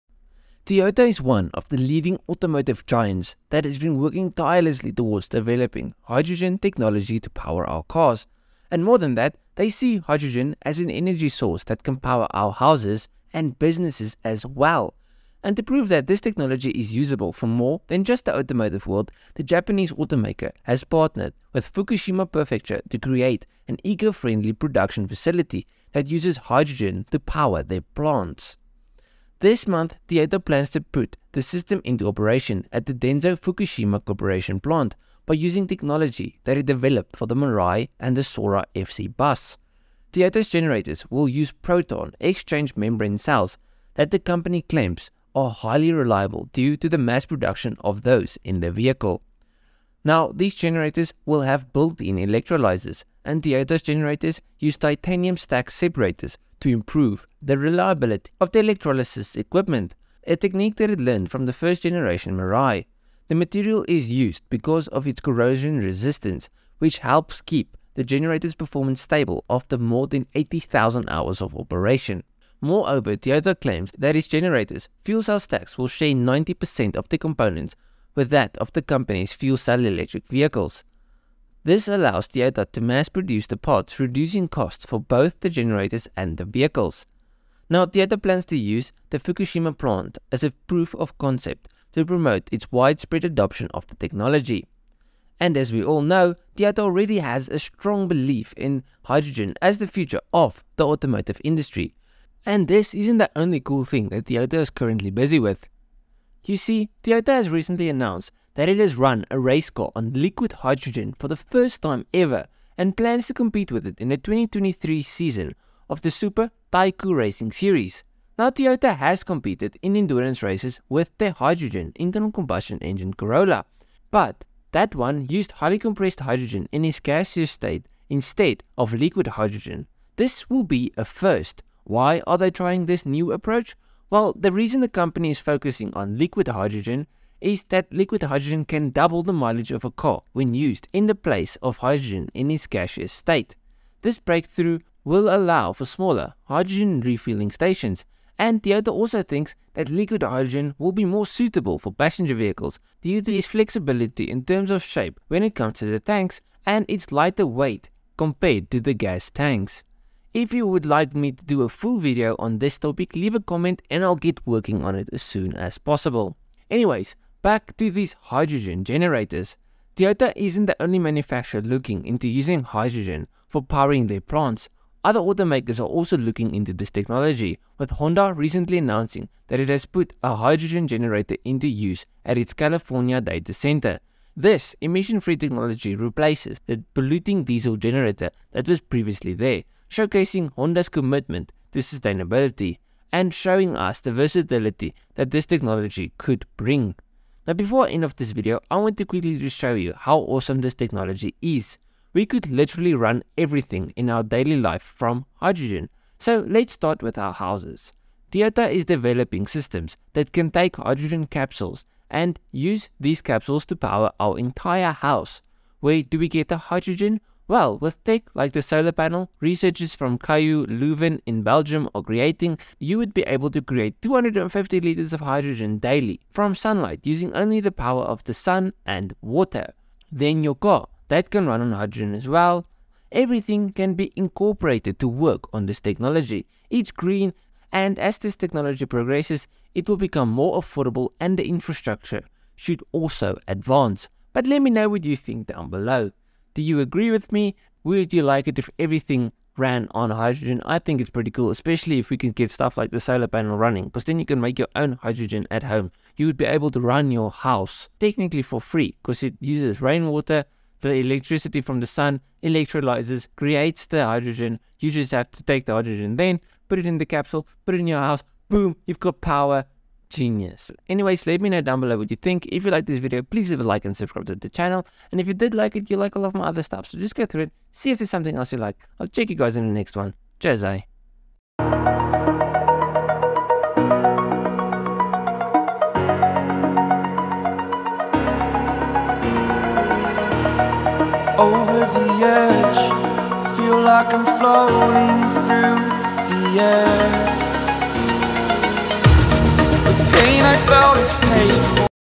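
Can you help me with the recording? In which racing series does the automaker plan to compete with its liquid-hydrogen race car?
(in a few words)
Super Taikyu Racing Series.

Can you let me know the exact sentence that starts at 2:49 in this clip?
Toyota isn't the only manufacturer looking into using hydrogen for powering their plants.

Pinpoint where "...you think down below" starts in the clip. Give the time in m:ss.
4:05.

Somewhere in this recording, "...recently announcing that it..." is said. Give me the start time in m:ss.
2:58.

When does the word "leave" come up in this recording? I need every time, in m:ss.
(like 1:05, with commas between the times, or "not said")
2:43, 4:33.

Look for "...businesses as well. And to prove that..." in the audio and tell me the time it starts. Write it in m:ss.
0:13.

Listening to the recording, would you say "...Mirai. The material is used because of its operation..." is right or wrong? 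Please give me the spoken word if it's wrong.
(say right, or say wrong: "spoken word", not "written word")
wrong: "corrosion", not "operation".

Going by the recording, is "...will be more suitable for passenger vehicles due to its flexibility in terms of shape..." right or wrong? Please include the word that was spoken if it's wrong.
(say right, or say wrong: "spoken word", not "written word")
right.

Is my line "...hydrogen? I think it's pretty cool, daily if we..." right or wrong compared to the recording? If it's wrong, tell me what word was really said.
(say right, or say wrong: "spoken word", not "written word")
wrong: "especially", not "daily".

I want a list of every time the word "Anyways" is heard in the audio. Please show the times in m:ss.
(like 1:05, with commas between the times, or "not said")
2:46, 4:30.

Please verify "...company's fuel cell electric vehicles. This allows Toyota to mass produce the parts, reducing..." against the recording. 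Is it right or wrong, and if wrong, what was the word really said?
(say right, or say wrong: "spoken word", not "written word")
right.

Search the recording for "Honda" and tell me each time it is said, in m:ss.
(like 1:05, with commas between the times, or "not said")
2:57, 3:10.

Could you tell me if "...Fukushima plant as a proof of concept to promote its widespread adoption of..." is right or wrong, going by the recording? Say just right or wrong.
right.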